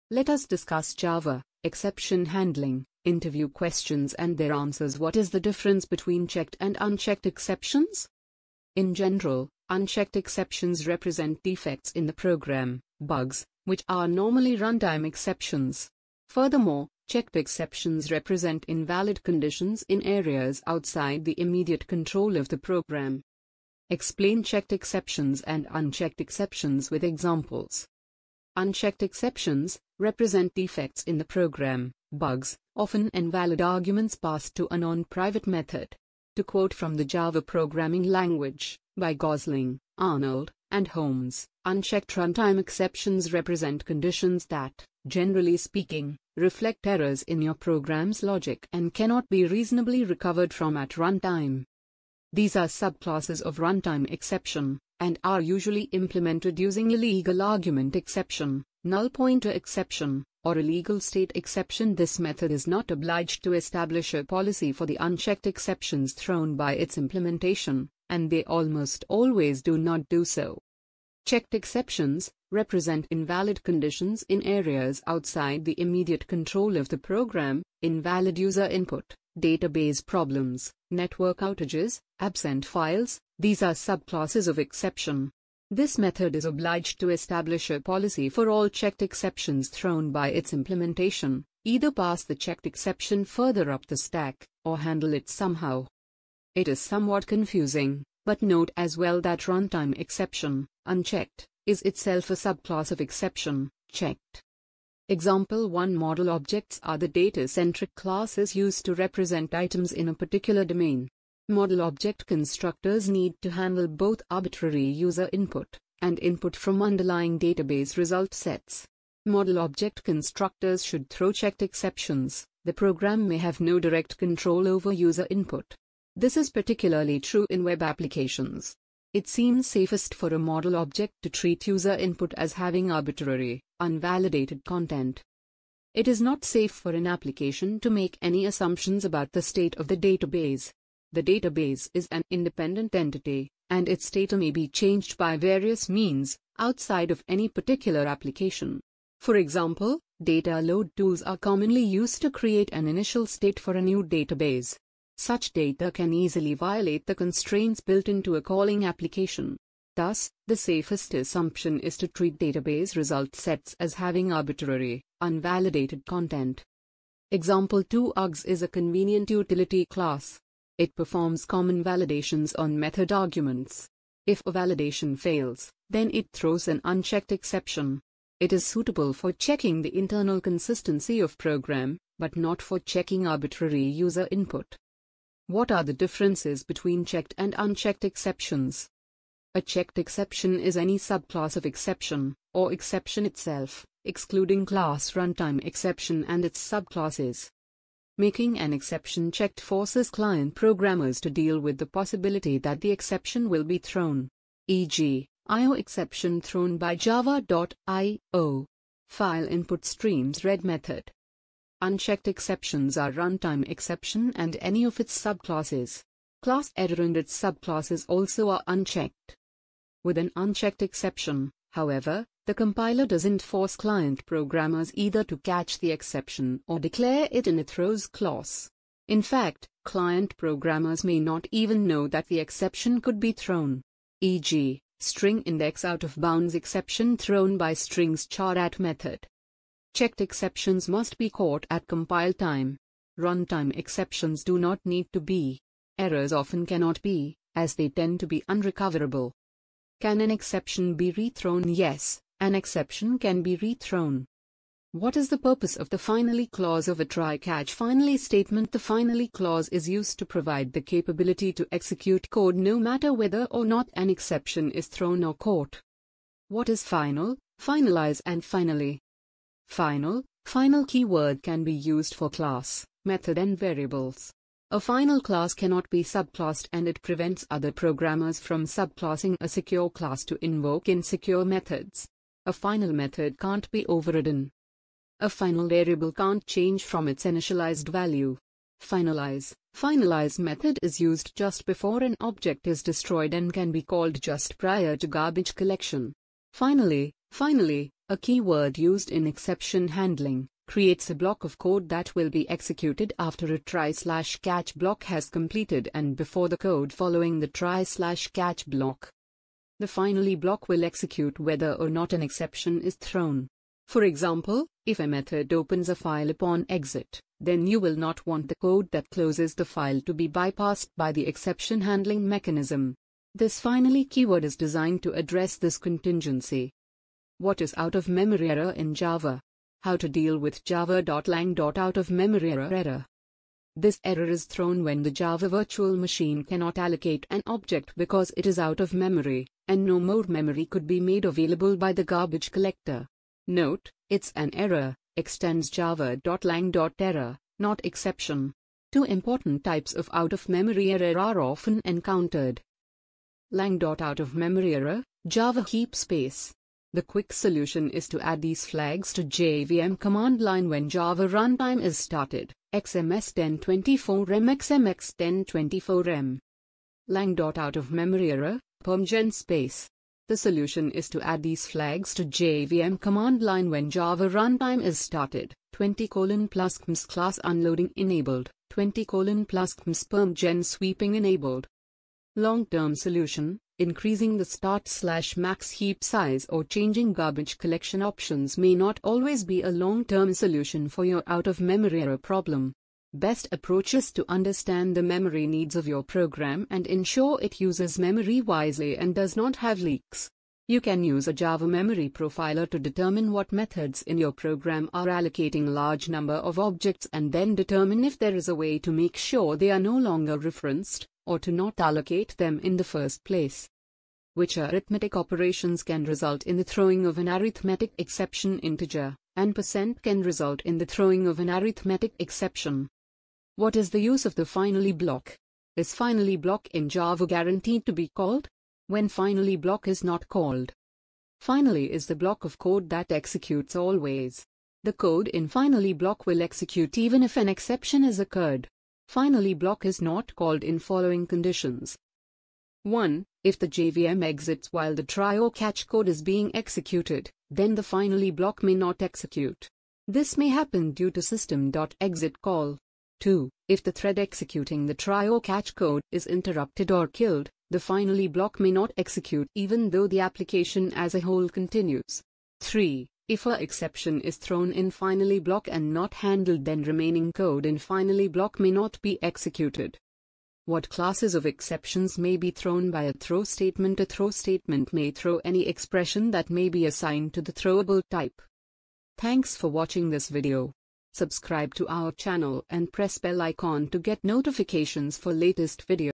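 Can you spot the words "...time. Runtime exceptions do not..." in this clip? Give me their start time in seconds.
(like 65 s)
242 s.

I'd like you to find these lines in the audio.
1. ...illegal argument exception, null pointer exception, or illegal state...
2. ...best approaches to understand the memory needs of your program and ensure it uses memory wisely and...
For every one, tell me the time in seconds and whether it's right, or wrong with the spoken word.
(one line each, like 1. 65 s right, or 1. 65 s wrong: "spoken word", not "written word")
1. 56 s right
2. 393 s right.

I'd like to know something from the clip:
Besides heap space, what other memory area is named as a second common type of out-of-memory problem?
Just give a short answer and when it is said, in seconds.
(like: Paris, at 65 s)
PermGen space, at 368 s.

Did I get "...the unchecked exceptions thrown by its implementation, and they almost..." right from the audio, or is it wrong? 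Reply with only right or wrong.
right.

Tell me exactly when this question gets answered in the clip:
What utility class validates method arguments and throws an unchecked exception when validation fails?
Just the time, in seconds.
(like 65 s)
168 s.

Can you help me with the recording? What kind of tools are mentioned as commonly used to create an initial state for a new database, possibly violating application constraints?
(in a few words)
data load tools.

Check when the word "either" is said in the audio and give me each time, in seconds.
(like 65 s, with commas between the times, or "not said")
91 s, 224 s.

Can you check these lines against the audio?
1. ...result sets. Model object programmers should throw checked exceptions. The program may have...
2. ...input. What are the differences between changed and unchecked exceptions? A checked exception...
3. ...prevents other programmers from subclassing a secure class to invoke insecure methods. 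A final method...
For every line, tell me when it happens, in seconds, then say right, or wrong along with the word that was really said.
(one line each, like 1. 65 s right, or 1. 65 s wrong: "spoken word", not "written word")
1. 117 s wrong: "constructors", not "programmers"
2. 184 s wrong: "checked", not "changed"
3. 277 s right.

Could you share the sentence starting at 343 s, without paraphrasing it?
Note, it's an error, extends java.lang.error, not exception.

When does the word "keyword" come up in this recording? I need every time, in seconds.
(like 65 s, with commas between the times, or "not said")
270 s, 298 s, 324 s.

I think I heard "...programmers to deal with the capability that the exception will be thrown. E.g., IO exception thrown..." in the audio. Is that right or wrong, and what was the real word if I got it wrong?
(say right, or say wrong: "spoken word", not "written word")
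wrong: "possibility", not "capability".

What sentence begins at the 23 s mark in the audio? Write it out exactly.
Explain checked exceptions and unchecked exceptions with examples.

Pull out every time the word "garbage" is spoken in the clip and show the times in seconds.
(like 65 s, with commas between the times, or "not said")
295 s, 342 s, 387 s.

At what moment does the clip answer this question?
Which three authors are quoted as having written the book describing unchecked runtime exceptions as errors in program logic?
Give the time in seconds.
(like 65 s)
39 s.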